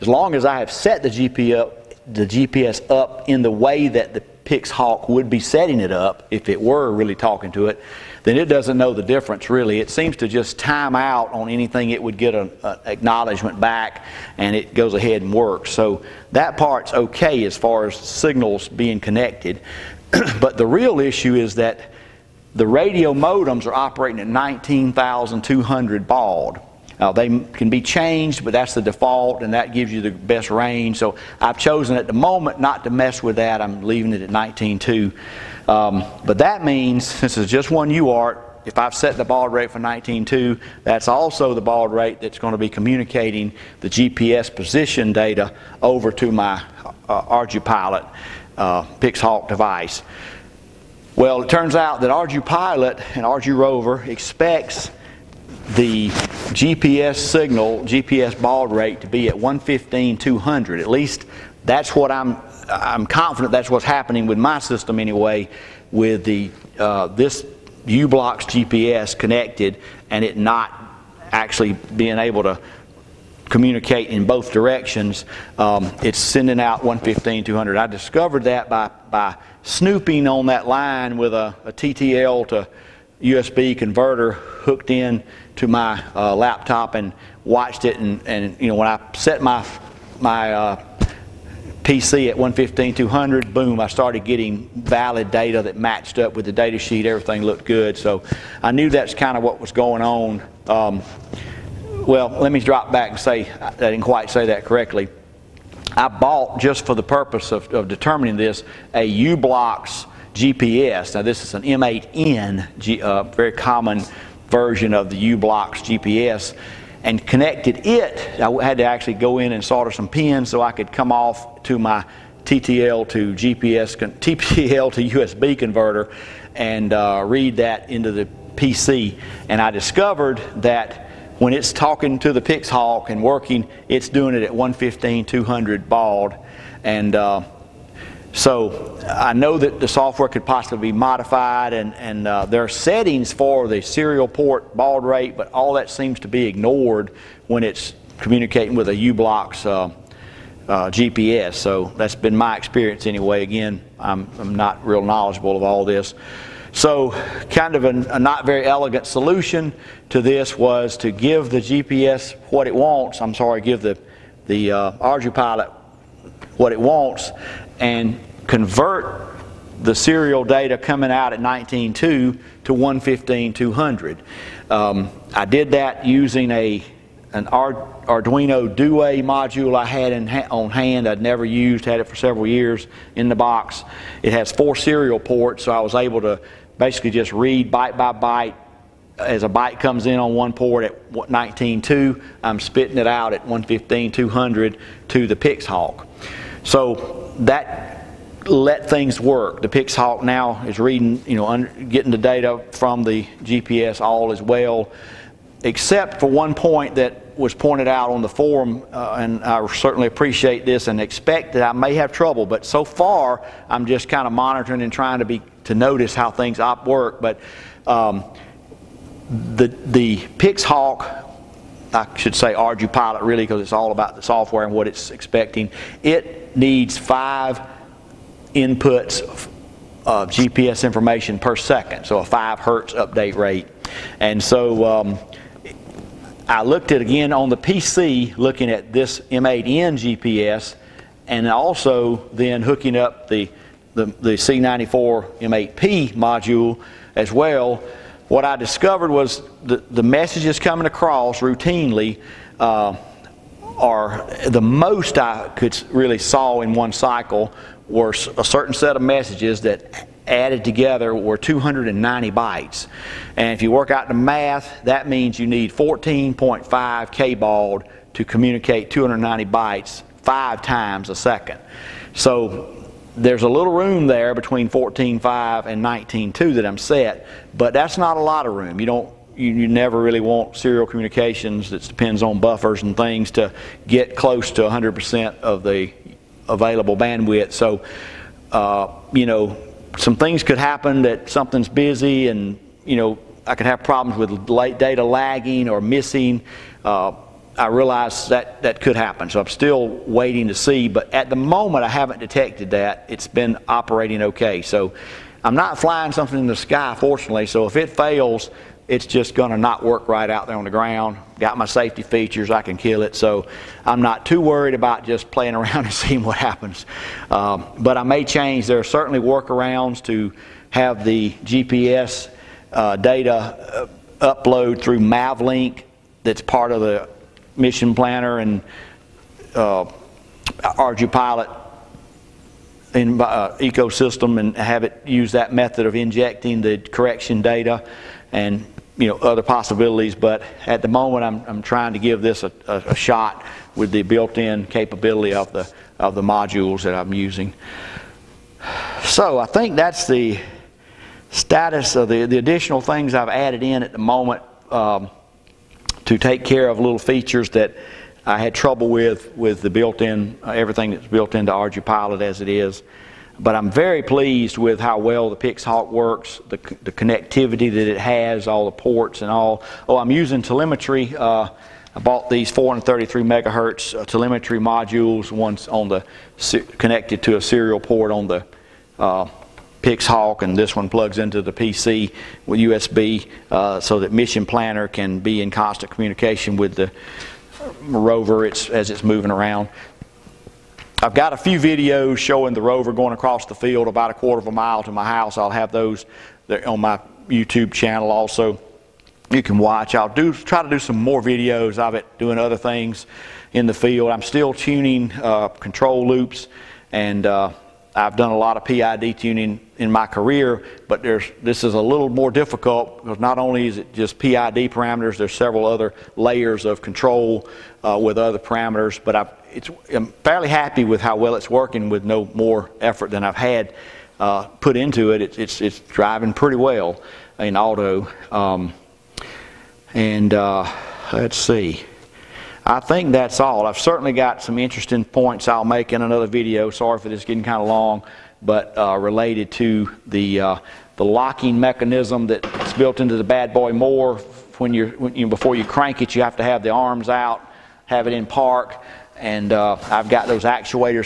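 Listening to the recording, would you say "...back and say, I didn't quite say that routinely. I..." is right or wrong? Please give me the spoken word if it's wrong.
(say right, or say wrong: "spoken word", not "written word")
wrong: "correctly", not "routinely".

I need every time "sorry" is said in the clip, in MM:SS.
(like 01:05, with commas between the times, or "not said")
02:43, 07:16.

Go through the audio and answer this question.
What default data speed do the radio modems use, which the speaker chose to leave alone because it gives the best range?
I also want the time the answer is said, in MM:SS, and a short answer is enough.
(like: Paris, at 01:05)
19,200 baud, at 00:24.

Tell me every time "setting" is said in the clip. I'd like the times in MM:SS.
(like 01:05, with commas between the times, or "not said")
00:05, 02:22.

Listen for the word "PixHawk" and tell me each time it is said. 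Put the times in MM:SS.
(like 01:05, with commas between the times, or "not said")
00:04, 00:48, 03:15, 03:19, 03:40, 06:05, 06:19.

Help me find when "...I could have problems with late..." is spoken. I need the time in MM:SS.
04:53.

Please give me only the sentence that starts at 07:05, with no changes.
It's, it's, driving pretty well in auto.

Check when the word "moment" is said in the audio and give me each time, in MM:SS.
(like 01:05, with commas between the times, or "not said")
00:32, 05:01, 05:40, 05:53.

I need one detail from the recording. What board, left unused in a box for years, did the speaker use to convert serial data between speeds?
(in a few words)
Arduino Due.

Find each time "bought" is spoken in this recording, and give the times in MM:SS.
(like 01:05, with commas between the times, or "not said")
01:46, 06:11.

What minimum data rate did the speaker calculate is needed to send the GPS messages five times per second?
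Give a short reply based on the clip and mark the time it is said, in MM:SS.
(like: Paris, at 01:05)
14.5 kbaud, at 04:25.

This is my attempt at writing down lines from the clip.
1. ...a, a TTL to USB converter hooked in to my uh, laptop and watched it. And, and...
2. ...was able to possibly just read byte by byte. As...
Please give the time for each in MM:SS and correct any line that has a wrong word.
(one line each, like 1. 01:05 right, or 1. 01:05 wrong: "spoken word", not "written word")
1. 01:21 right
2. 03:05 wrong: "basically", not "possibly".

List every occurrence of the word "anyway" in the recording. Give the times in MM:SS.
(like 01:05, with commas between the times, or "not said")
01:04, 02:33.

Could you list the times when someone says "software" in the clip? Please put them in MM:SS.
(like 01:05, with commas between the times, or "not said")
02:19, 03:44.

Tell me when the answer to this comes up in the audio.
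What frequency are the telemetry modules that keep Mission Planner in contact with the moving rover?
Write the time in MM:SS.
06:12.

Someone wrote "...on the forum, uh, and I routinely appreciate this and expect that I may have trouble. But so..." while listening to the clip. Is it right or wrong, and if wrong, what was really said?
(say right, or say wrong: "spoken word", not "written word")
wrong: "certainly", not "routinely".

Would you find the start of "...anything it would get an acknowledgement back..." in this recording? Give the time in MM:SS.
00:11.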